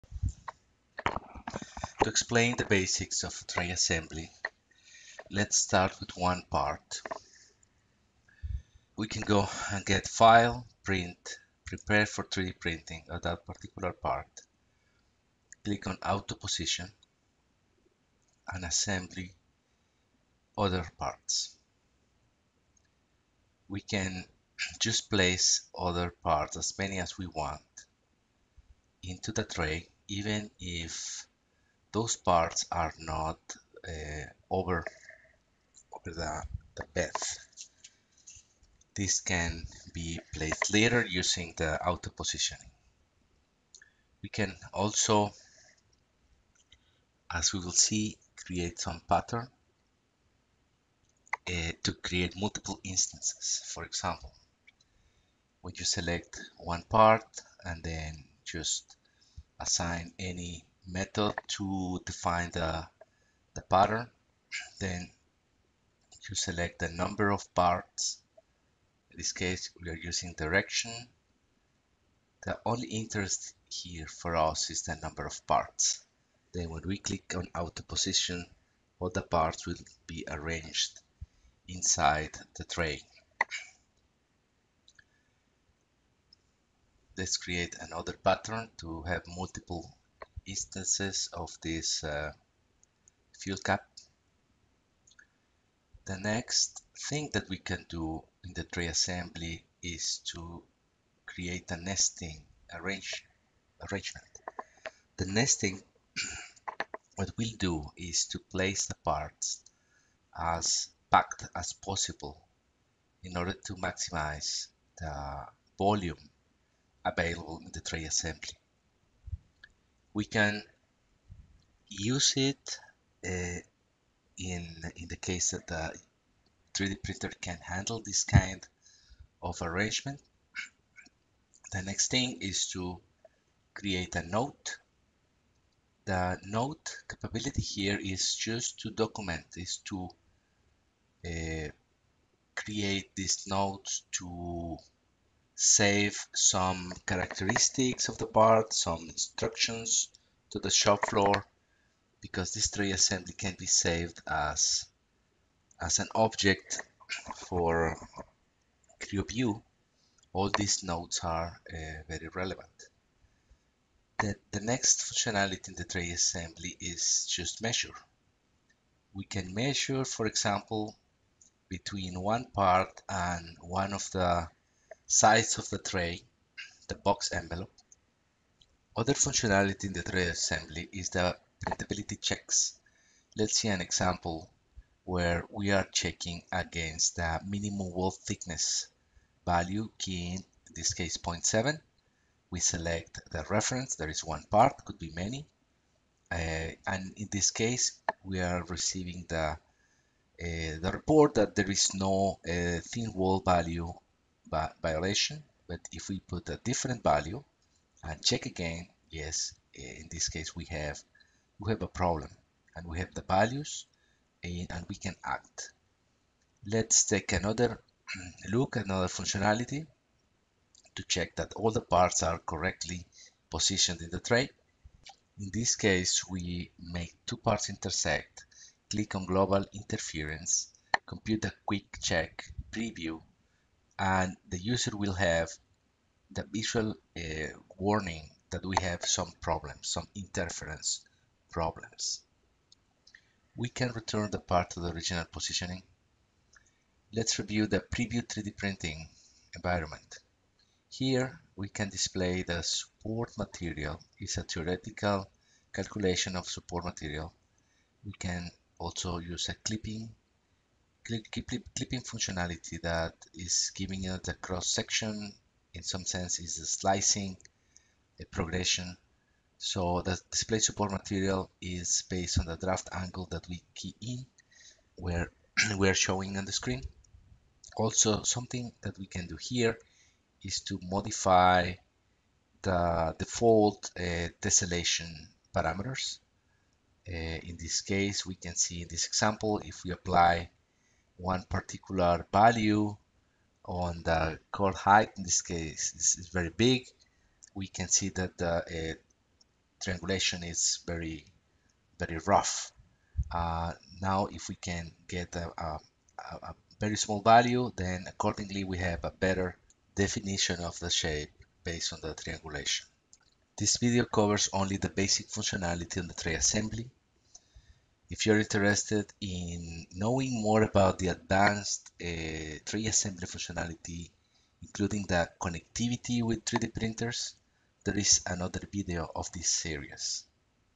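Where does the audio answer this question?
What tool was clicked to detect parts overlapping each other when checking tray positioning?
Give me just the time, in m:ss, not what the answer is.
3:49.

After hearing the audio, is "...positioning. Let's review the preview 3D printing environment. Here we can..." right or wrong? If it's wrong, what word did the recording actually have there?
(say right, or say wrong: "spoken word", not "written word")
right.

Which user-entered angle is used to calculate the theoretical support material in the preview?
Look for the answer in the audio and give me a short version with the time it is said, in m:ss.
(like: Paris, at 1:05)
Draft angle, at 4:32.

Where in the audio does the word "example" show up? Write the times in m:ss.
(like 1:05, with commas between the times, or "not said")
0:53, 2:50, 3:03, 4:49.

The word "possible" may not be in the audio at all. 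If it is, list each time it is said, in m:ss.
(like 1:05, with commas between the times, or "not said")
1:51.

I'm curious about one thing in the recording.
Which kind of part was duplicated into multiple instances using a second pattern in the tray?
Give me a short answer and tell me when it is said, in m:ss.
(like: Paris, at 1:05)
Fuel cap, at 1:33.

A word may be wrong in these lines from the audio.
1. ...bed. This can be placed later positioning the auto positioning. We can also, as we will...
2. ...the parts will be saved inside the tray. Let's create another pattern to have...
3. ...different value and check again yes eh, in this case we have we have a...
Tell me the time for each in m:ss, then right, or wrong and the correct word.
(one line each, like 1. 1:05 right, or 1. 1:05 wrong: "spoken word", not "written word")
1. 0:36 wrong: "using", not "positioning"
2. 1:19 wrong: "arranged", not "saved"
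3. 3:26 right.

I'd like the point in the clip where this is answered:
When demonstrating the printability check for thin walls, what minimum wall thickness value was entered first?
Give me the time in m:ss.
3:11.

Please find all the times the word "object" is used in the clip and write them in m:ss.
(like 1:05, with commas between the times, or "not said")
2:36.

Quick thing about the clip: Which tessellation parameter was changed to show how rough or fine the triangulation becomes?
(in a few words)
Chord height.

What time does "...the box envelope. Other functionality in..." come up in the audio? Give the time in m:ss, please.
2:56.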